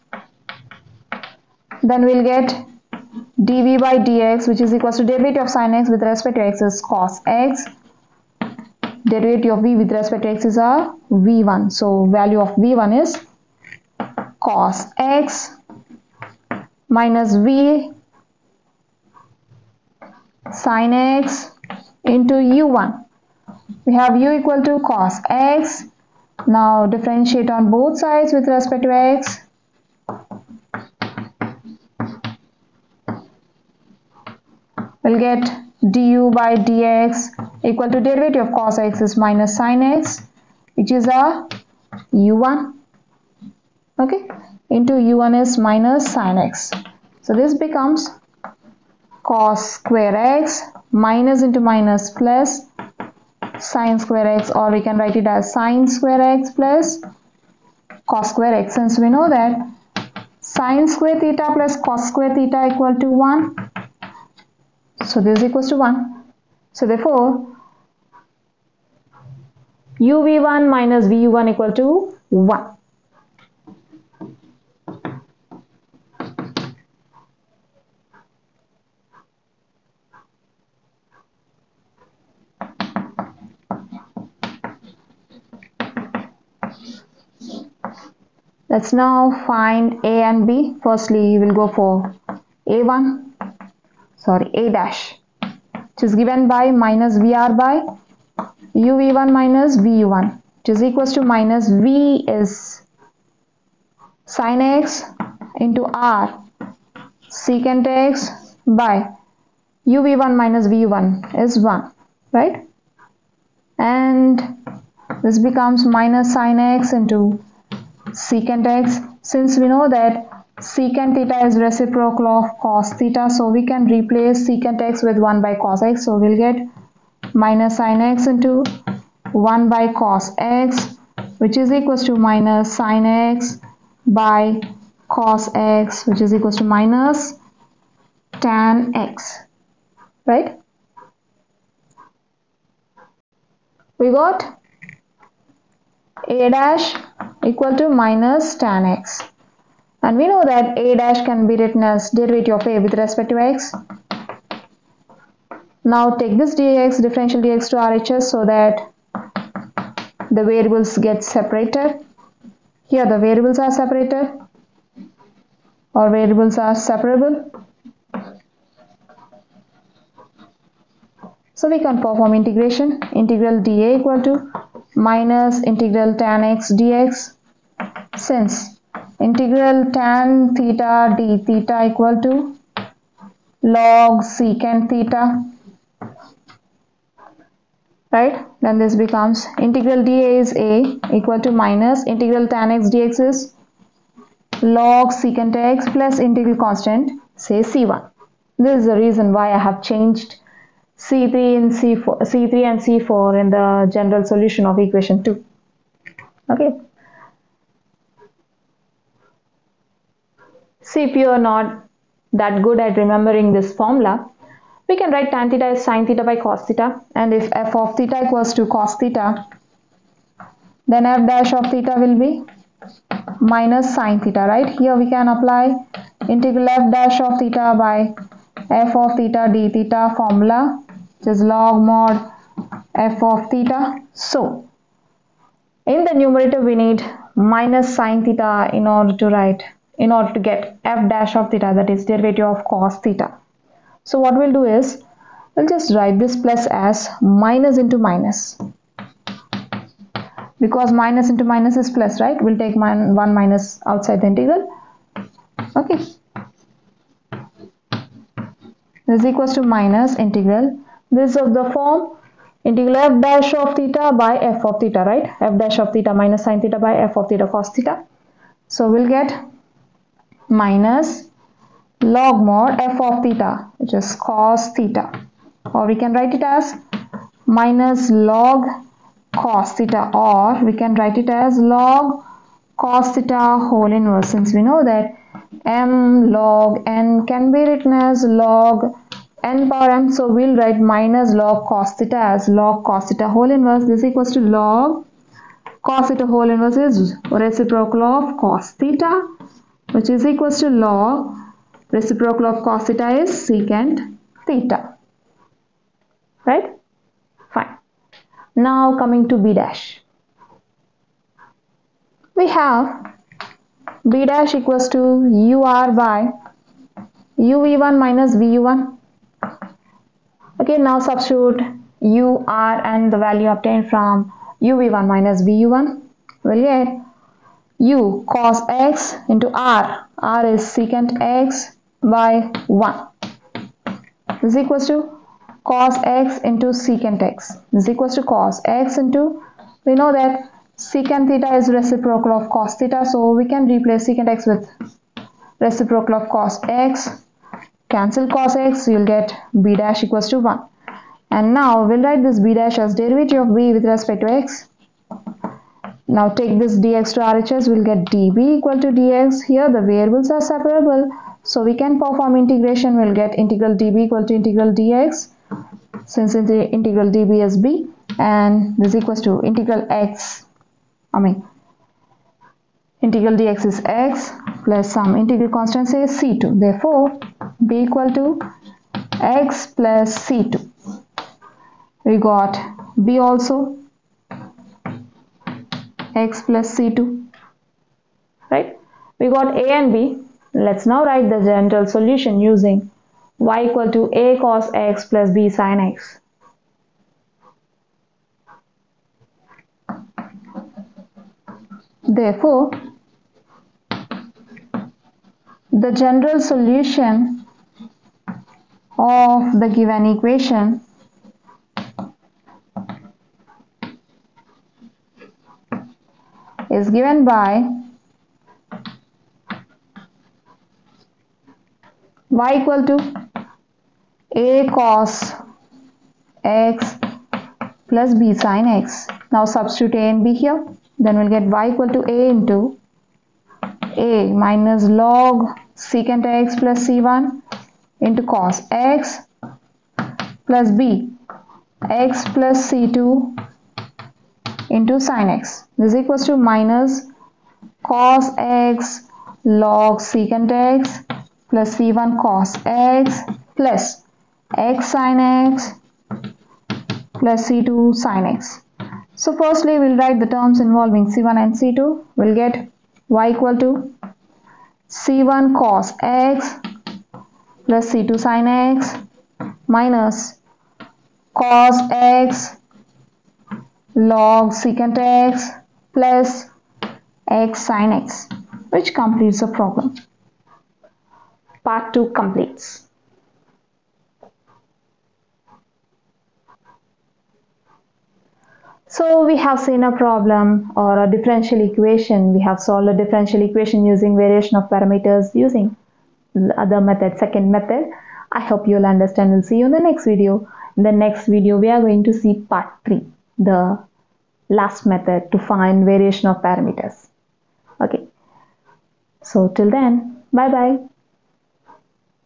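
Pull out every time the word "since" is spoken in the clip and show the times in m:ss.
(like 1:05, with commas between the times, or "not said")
0:58, 1:59, 2:58, 4:44, 6:06.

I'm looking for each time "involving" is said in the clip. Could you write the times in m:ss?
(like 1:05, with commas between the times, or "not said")
7:40.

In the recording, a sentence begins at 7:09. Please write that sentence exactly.
Now substitute a and b here.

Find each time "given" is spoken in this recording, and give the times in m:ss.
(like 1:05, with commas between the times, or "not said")
1:36, 6:49, 6:56.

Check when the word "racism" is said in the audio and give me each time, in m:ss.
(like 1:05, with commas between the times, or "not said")
not said.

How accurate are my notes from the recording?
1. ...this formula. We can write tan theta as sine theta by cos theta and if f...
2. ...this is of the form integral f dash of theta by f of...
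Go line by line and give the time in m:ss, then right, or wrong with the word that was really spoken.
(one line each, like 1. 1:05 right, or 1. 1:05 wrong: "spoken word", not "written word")
1. 3:33 right
2. 4:21 right.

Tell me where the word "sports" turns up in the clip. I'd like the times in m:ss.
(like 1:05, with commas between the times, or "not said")
not said.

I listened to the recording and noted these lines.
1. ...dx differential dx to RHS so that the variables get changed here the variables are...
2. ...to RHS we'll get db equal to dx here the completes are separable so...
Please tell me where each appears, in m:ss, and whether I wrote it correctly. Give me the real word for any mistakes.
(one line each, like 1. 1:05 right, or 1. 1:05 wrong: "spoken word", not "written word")
1. 2:36 wrong: "separated", not "changed"
2. 5:57 wrong: "variables", not "completes".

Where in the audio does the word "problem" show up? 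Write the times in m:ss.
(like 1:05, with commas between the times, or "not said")
7:59, 8:10.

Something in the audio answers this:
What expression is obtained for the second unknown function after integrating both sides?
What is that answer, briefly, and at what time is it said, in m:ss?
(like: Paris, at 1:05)
x plus c2, at 6:17.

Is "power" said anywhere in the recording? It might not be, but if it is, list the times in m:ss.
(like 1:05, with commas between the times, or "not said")
4:49.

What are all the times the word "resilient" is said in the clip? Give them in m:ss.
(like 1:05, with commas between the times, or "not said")
not said.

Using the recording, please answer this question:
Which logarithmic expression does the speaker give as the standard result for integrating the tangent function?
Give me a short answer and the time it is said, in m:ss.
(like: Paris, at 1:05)
log secant theta, at 3:03.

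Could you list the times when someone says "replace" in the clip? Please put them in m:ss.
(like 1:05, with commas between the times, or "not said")
2:03, 5:43.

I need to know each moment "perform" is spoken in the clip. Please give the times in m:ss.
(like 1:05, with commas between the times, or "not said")
2:52, 6:01.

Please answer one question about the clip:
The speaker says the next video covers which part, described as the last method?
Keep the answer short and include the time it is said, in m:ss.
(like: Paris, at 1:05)
part 3, at 8:22.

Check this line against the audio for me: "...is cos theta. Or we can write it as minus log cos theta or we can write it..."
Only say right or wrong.
right.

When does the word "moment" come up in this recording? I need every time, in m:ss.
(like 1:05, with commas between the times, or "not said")
not said.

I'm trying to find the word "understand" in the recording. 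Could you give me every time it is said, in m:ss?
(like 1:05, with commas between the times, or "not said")
8:18.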